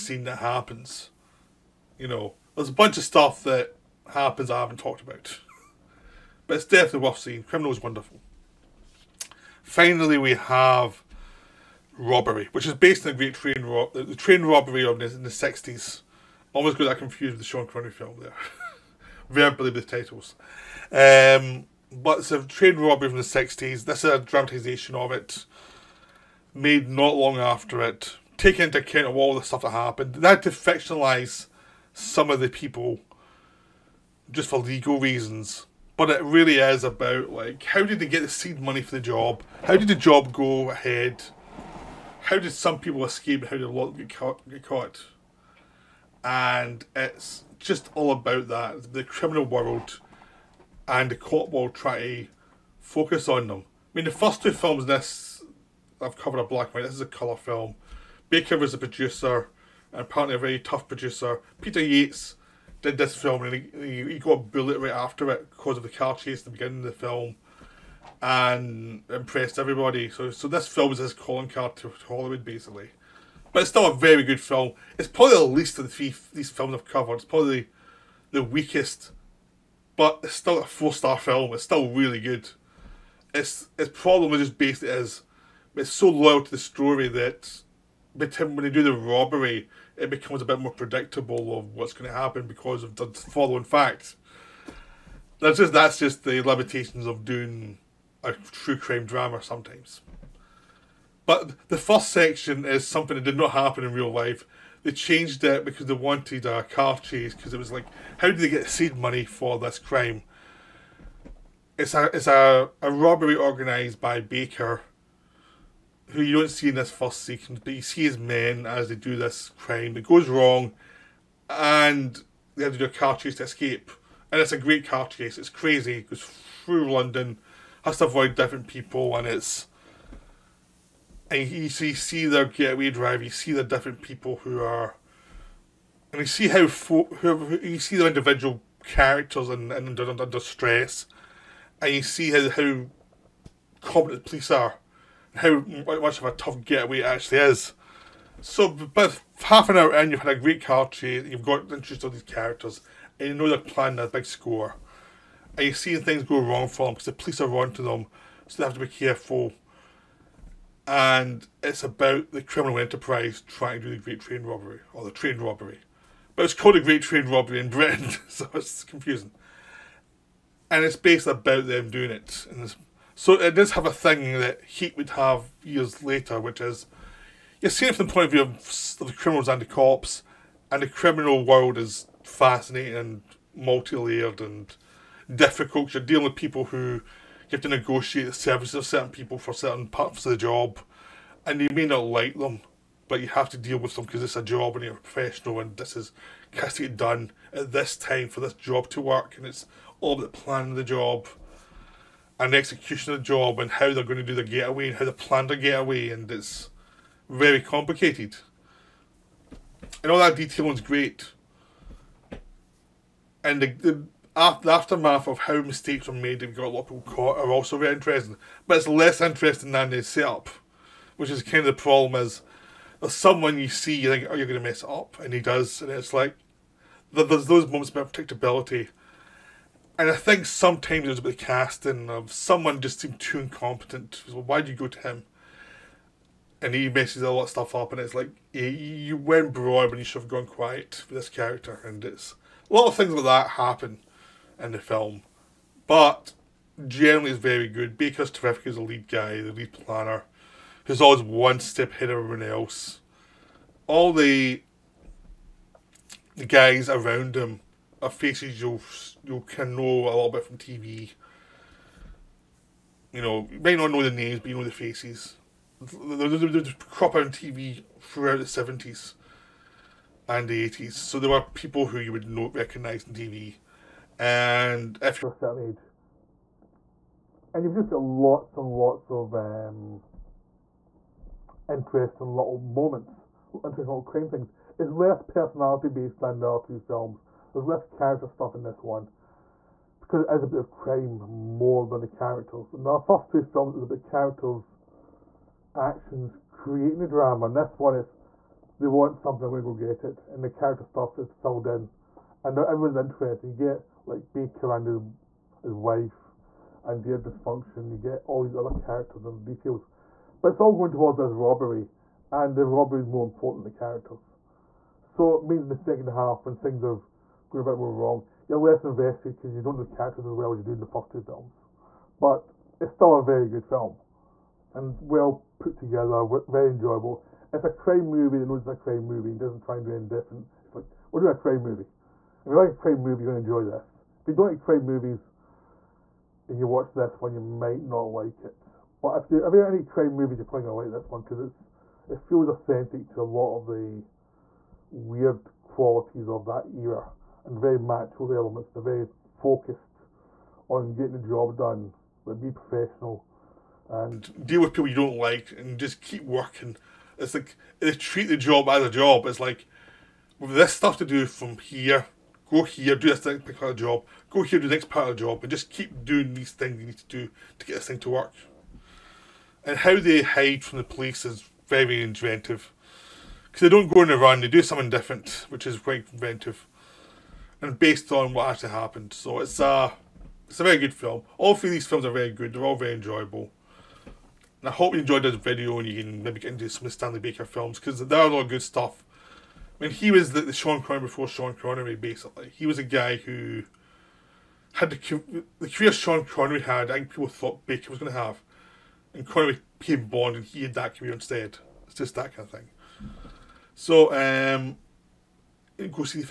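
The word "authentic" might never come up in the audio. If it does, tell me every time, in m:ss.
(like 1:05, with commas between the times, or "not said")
5:42.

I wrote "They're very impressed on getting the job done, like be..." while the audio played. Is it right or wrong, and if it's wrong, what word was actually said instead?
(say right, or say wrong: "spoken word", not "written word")
wrong: "focused", not "impressed".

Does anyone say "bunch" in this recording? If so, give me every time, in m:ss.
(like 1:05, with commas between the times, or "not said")
0:02.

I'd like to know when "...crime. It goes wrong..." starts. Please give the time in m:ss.
1:59.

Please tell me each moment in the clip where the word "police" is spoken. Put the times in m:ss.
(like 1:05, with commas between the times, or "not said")
2:24, 2:37, 6:10.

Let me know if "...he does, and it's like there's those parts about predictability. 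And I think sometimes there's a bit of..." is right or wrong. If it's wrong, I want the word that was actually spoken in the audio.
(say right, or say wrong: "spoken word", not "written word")
wrong: "moments", not "parts".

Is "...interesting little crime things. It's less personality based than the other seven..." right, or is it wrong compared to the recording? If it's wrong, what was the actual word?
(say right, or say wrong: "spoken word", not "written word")
wrong: "two", not "seven".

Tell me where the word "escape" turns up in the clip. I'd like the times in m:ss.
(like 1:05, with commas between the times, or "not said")
0:43, 2:03.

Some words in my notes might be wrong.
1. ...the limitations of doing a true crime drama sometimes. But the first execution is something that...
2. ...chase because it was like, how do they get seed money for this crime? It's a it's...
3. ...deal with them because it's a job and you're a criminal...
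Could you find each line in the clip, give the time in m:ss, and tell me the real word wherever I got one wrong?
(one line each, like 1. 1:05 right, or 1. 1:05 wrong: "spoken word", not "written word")
1. 1:36 wrong: "section", not "execution"
2. 1:46 right
3. 3:13 wrong: "professional", not "criminal".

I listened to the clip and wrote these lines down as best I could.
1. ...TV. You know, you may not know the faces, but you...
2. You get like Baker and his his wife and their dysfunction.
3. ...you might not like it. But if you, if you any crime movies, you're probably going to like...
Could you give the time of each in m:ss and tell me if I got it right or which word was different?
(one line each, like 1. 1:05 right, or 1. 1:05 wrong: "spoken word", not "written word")
1. 4:20 wrong: "names", not "faces"
2. 5:03 right
3. 5:37 right.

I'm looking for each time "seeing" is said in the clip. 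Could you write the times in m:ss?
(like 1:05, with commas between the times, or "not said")
0:07, 2:35, 2:57.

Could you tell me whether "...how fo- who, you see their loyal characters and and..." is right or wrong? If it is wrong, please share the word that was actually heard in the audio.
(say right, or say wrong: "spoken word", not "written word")
wrong: "individual", not "loyal".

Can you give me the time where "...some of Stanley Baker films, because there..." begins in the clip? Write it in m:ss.
6:26.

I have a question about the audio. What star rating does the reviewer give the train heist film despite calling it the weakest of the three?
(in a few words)
4 stars.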